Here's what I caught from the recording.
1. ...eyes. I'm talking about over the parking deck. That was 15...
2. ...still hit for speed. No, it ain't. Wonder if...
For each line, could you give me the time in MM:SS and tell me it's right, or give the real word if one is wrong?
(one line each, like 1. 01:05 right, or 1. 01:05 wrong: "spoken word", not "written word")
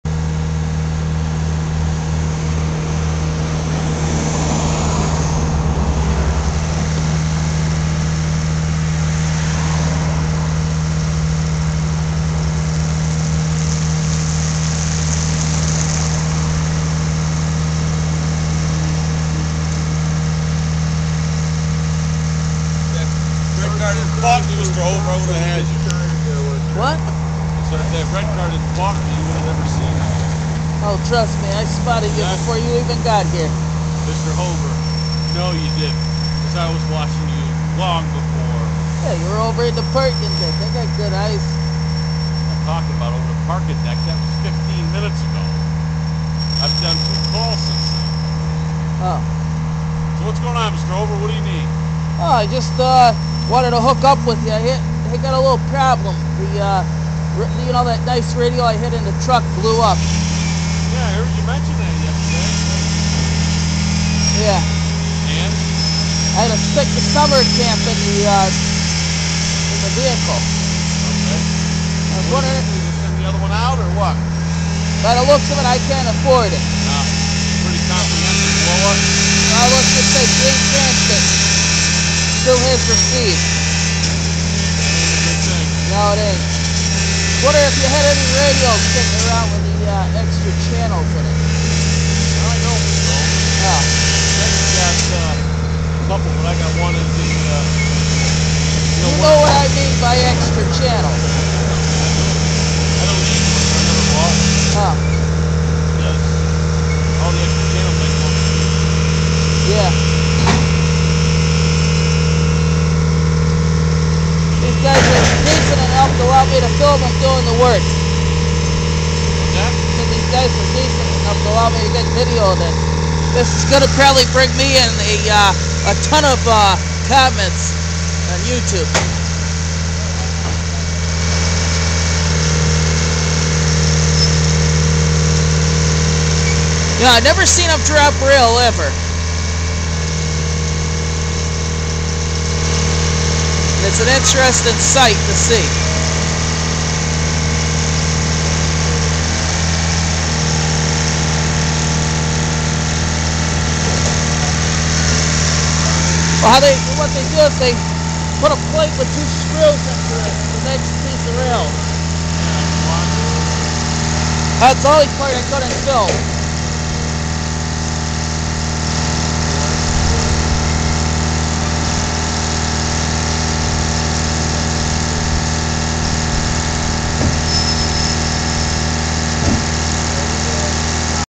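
1. 00:41 right
2. 01:22 right.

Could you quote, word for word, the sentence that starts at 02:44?
That's the only part I couldn't fill.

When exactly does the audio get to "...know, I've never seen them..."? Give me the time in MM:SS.
02:17.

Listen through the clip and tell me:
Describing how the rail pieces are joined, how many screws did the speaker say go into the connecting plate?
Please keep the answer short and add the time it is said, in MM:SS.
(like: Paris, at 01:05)
2, at 02:39.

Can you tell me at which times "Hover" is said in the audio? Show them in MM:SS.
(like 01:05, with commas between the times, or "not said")
00:34, 00:50.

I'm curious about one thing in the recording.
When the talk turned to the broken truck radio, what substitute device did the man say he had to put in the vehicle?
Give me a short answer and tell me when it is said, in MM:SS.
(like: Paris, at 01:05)
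summer camp, at 01:07.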